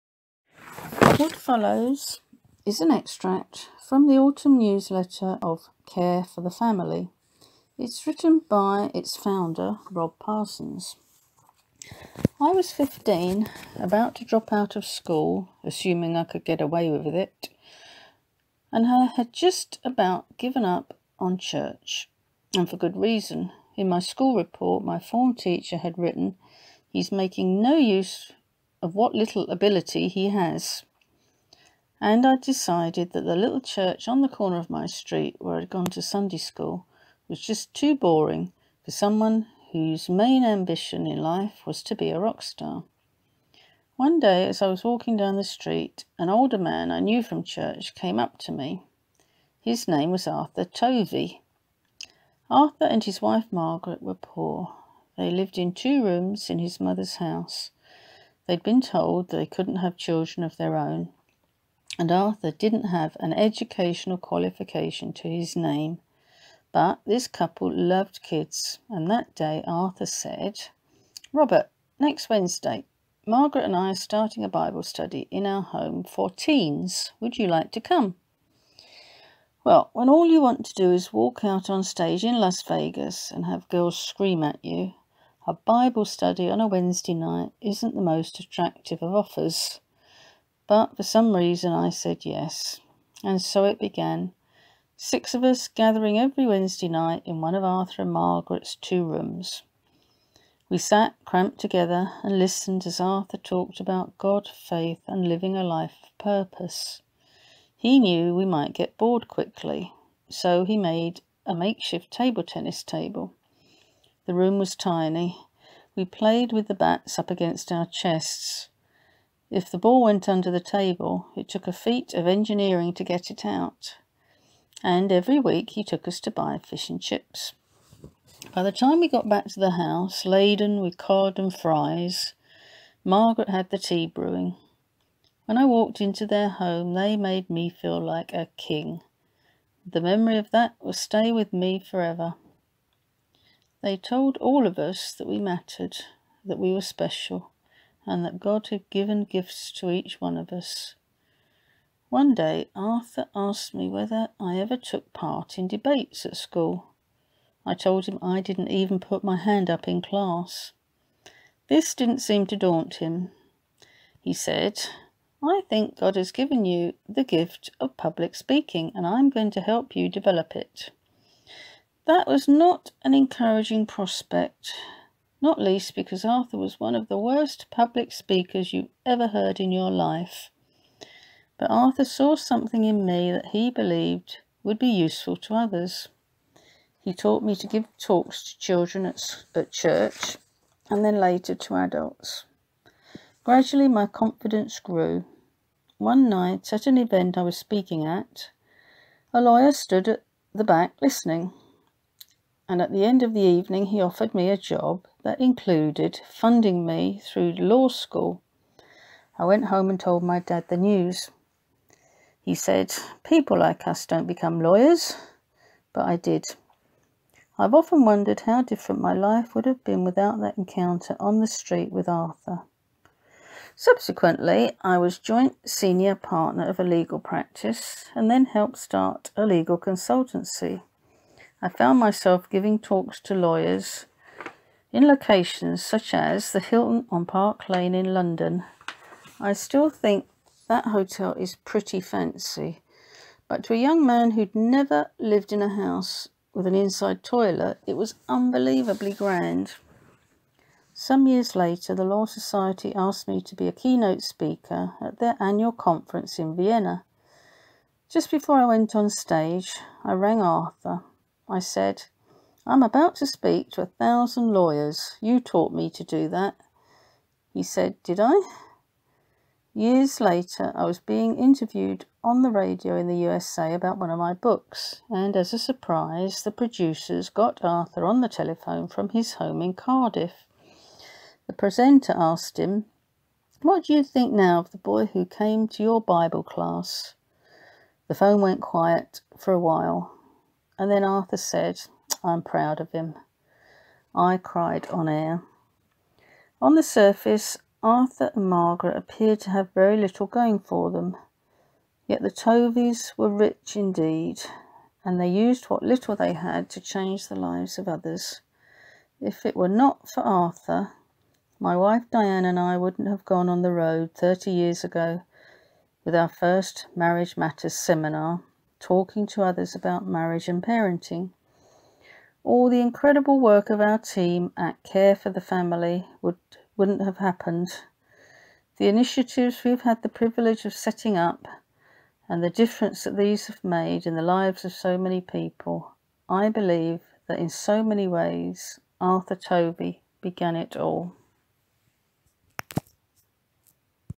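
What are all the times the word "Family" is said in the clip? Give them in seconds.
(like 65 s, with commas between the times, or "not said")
6 s, 325 s.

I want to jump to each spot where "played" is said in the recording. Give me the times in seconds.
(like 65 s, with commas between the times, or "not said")
116 s.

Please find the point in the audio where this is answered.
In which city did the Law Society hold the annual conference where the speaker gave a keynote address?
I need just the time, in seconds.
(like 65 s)
256 s.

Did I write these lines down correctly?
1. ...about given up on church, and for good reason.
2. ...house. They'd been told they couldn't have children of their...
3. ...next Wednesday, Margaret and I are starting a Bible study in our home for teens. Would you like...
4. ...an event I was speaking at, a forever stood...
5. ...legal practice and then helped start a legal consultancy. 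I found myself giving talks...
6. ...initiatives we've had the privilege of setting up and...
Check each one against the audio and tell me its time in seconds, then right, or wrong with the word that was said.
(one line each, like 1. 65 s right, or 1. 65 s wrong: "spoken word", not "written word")
1. 19 s right
2. 57 s right
3. 71 s right
4. 196 s wrong: "lawyer", not "forever"
5. 226 s right
6. 328 s right.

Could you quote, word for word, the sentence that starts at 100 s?
We sat cramped together and listened as Arthur talked about God, faith, and living a life of purpose.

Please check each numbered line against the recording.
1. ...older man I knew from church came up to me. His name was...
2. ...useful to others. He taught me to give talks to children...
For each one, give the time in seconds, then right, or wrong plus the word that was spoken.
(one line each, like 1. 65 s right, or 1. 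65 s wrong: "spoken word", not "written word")
1. 46 s right
2. 184 s right.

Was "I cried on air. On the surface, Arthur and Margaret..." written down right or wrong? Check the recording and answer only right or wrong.
right.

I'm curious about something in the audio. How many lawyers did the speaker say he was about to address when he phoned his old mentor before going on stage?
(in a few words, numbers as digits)
1000.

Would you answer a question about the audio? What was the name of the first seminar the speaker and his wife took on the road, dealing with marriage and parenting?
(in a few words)
Marriage Matters.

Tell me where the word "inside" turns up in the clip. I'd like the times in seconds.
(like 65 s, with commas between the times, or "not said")
246 s.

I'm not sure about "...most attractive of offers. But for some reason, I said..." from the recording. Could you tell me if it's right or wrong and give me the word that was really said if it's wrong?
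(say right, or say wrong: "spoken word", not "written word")
right.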